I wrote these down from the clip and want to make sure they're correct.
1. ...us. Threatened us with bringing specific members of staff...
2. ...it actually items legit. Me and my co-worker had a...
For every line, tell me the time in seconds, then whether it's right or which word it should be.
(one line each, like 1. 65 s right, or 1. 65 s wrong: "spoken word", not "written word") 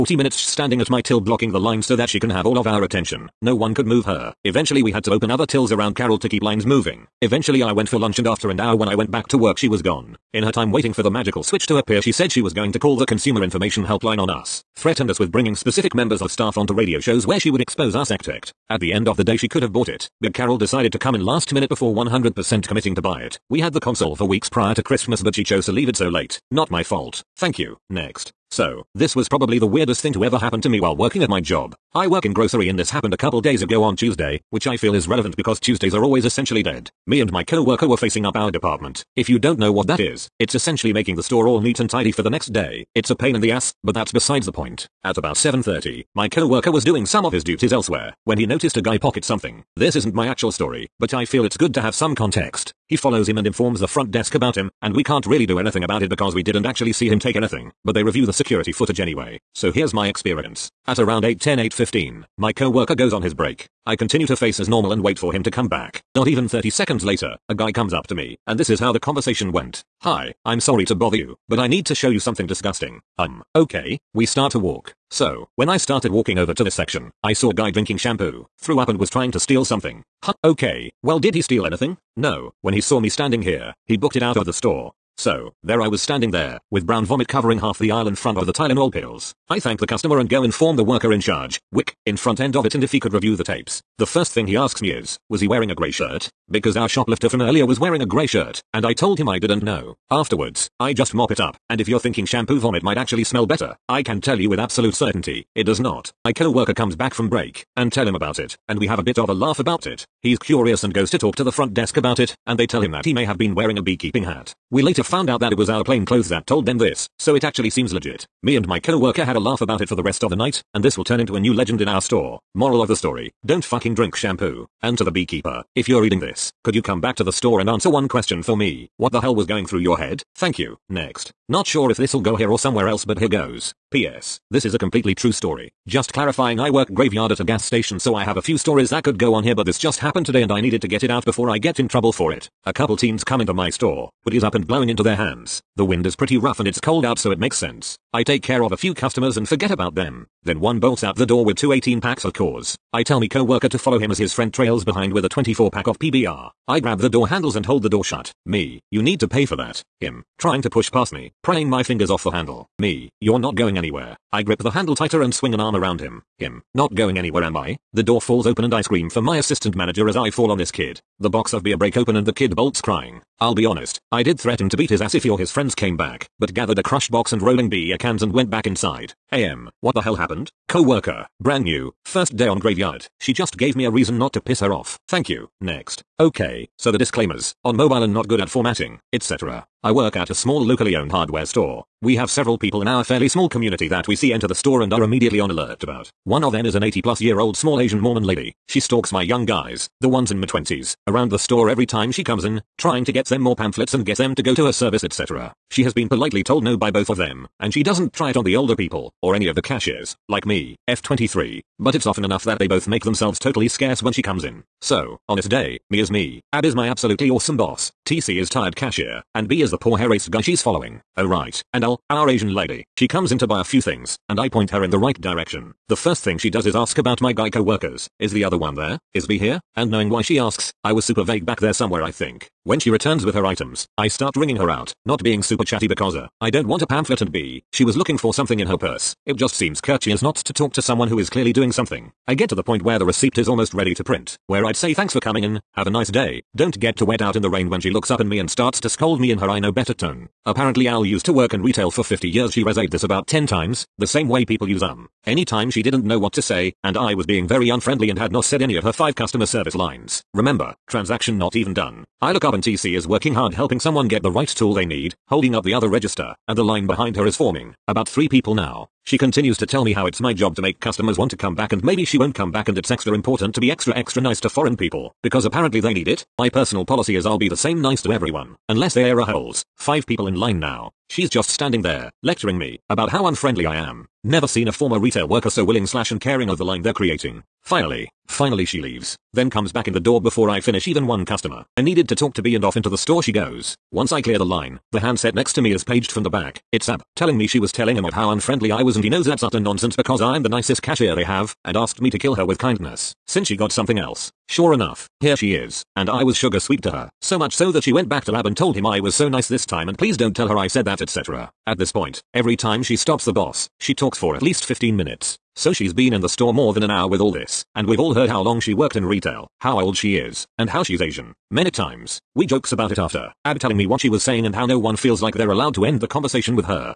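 1. 14 s right
2. 117 s wrong: "seems", not "items".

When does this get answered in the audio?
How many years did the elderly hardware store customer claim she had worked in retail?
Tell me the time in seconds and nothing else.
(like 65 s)
252 s.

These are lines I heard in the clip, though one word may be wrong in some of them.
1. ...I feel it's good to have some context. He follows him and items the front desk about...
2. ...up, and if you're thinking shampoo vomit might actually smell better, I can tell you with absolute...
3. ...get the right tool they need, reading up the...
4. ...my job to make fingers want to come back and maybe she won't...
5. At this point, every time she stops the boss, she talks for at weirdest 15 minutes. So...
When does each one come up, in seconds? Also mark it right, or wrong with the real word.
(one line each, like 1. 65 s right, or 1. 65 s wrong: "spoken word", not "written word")
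1. 51 s wrong: "informs", not "items"
2. 101 s right
3. 264 s wrong: "holding", not "reading"
4. 270 s wrong: "customers", not "fingers"
5. 311 s wrong: "least", not "weirdest".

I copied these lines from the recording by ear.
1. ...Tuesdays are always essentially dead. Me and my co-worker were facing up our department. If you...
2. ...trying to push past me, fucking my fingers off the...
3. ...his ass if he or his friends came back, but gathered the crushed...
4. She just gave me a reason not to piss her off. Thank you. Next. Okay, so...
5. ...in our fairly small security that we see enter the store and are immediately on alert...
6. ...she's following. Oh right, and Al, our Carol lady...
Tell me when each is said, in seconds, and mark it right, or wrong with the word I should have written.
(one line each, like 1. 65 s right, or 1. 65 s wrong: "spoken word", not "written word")
1. 35 s right
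2. 160 s wrong: "prying", not "fucking"
3. 174 s right
4. 183 s right
5. 192 s wrong: "community", not "security"
6. 220 s wrong: "Asian", not "Carol".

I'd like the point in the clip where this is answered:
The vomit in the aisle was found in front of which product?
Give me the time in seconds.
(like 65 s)
88 s.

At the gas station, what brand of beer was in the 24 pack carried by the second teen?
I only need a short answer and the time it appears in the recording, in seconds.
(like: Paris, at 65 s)
PBR, at 155 s.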